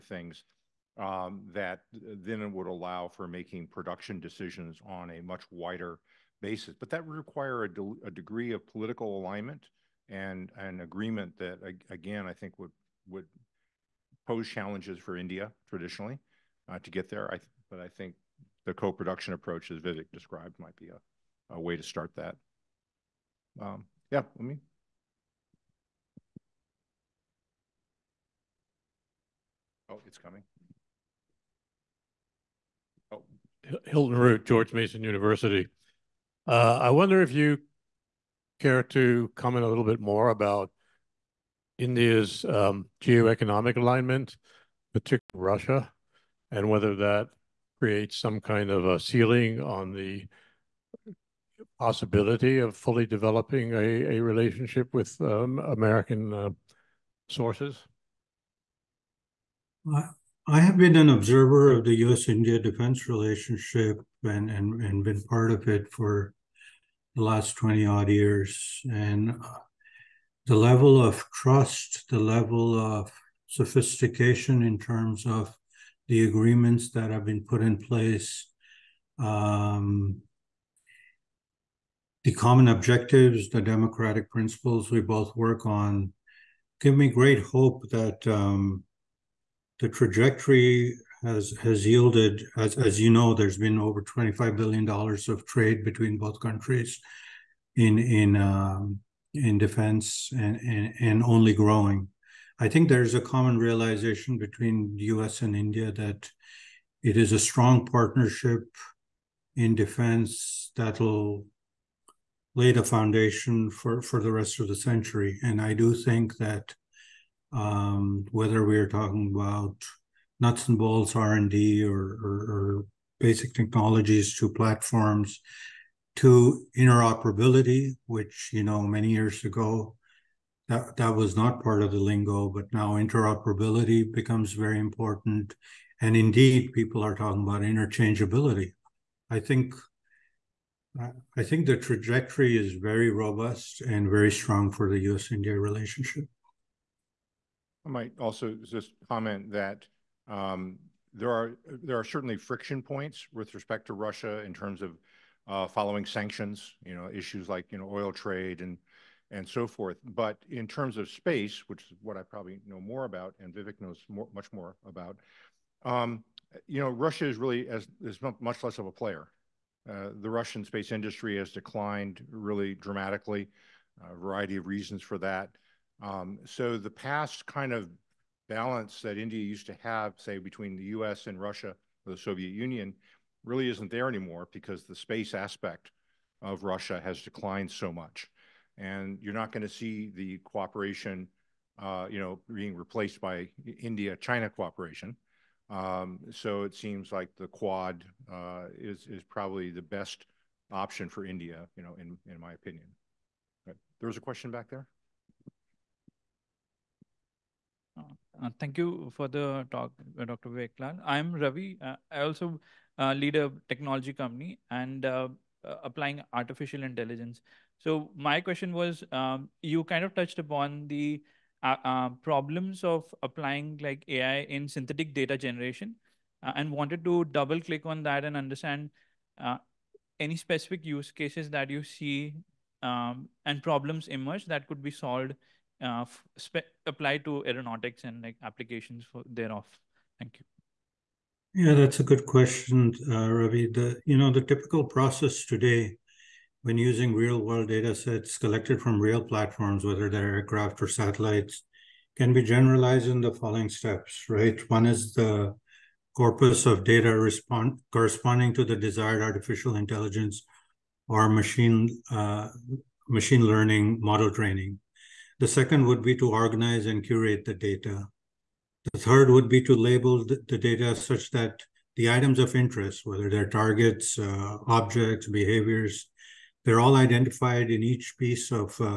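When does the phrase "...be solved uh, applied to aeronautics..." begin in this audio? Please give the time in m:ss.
3:54.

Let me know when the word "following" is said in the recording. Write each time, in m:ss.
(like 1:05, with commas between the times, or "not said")
2:35, 4:13.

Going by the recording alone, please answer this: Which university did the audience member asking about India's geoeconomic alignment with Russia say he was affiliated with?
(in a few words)
George Mason University.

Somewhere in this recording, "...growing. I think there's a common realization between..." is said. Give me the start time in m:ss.
1:41.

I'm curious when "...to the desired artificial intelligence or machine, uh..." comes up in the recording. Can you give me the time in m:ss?
4:18.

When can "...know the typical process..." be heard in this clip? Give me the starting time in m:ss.
4:04.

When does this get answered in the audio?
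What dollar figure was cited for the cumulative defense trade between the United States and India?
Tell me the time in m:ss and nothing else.
1:33.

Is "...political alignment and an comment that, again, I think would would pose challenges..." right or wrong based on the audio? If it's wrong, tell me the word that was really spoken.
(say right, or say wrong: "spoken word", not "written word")
wrong: "agreement", not "comment".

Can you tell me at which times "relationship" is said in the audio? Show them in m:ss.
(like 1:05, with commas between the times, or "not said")
0:54, 1:03, 2:25.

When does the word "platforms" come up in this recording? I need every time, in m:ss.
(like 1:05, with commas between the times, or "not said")
2:04, 4:09.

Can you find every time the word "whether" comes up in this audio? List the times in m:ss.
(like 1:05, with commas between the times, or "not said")
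0:46, 1:58, 4:09, 4:33.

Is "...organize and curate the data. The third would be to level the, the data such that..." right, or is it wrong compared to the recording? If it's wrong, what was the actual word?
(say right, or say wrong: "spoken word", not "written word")
wrong: "label", not "level".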